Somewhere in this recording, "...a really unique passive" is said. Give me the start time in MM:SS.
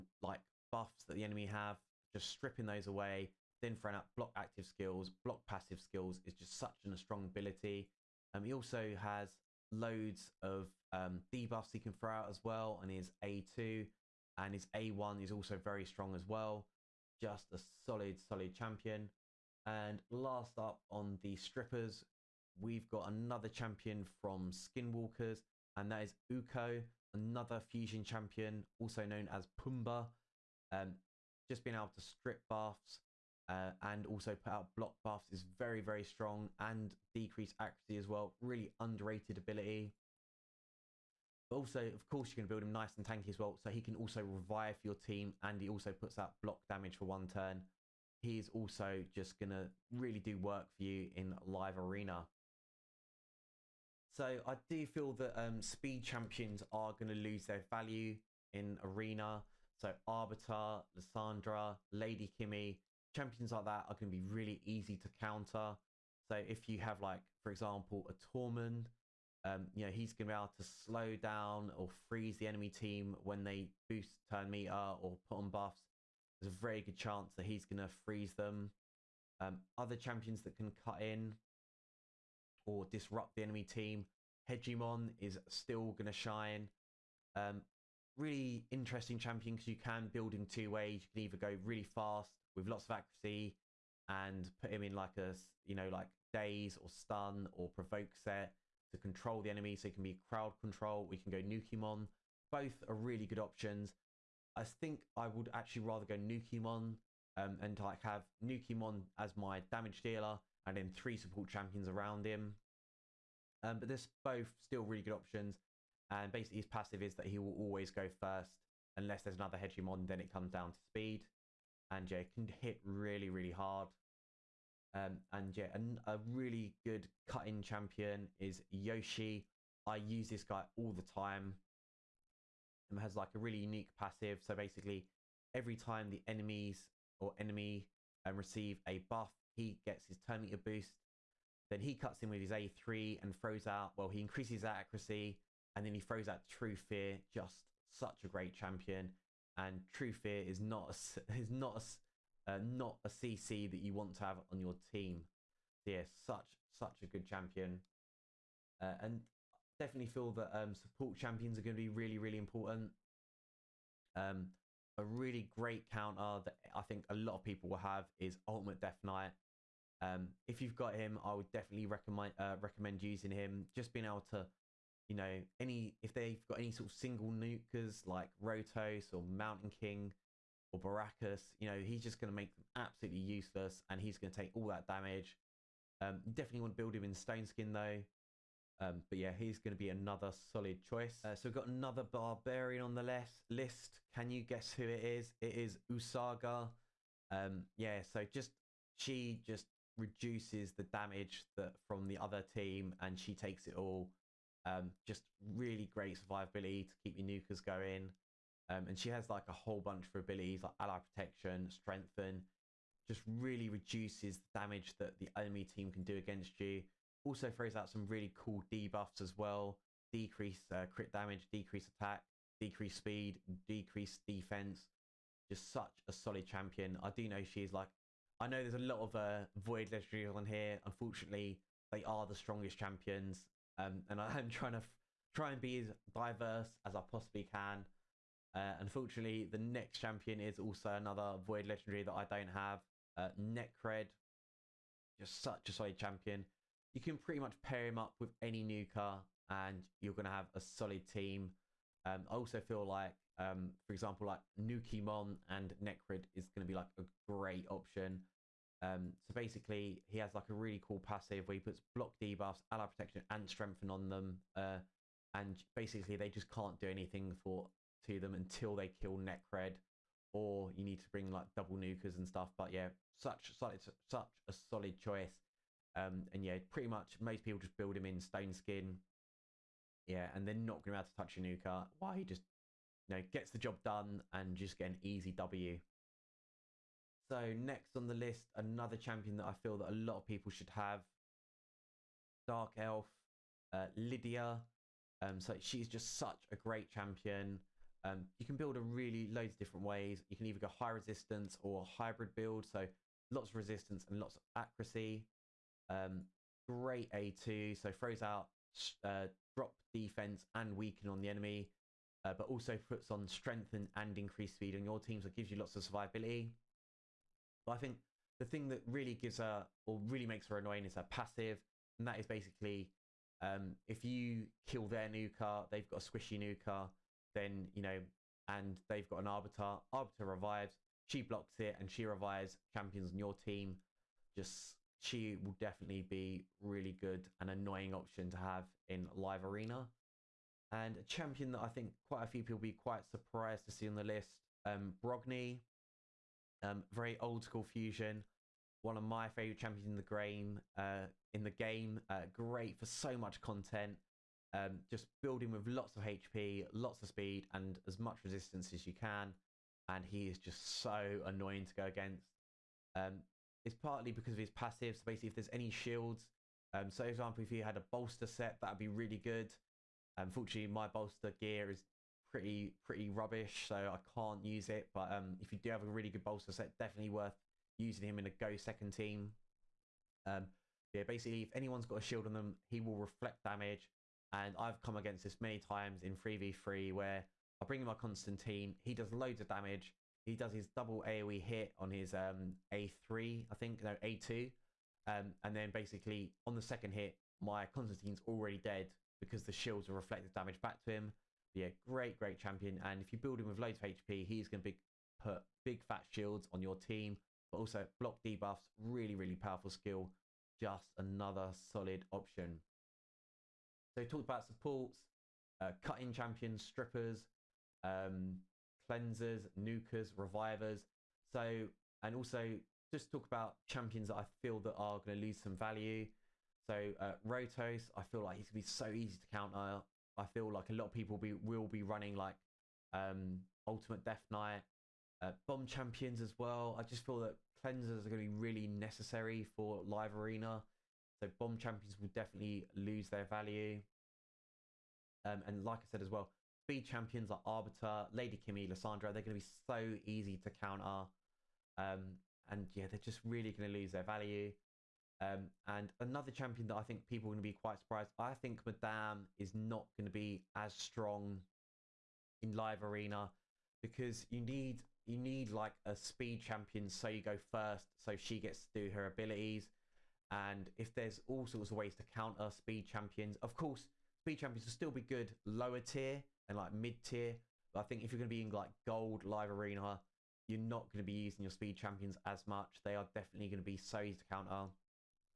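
02:13.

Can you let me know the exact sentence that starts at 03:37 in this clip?
Also throws out some really cool debuffs as well.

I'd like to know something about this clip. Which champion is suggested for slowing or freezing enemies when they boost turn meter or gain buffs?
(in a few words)
Tormin.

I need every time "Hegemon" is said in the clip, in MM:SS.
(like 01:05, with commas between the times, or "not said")
01:24, 01:59.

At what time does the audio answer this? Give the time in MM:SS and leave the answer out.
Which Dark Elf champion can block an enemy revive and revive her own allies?
04:53.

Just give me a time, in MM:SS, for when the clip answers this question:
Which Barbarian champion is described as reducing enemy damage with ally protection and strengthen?
03:15.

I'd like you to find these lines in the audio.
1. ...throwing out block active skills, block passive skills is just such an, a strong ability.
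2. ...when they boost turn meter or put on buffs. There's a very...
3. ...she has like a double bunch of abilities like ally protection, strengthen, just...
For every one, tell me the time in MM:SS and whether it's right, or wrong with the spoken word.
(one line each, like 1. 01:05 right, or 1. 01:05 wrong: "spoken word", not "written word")
1. 00:03 right
2. 01:13 right
3. 03:28 wrong: "whole", not "double".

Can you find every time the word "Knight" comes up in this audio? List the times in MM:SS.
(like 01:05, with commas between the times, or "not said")
02:49, 07:14.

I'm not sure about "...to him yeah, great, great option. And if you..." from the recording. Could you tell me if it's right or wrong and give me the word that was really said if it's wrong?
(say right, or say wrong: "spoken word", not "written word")
wrong: "champion", not "option".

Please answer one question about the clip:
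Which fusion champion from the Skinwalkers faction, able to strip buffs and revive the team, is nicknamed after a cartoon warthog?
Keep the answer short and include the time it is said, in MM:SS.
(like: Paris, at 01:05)
Pumba, at 00:29.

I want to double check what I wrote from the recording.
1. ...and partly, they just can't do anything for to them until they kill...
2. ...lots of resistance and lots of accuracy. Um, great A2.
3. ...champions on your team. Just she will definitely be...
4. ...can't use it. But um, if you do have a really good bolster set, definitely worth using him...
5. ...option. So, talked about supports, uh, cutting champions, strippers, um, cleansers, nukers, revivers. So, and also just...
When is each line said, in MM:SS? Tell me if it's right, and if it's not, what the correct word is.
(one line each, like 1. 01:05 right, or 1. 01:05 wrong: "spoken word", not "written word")
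1. 04:25 wrong: "basically", not "partly"
2. 05:03 right
3. 05:32 right
4. 06:13 right
5. 06:52 right.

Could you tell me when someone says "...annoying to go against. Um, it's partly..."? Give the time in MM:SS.
06:01.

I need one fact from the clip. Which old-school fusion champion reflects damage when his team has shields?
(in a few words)
Brogni.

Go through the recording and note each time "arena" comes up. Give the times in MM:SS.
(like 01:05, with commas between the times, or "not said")
00:51, 00:58, 05:39, 07:20, 07:42, 07:59.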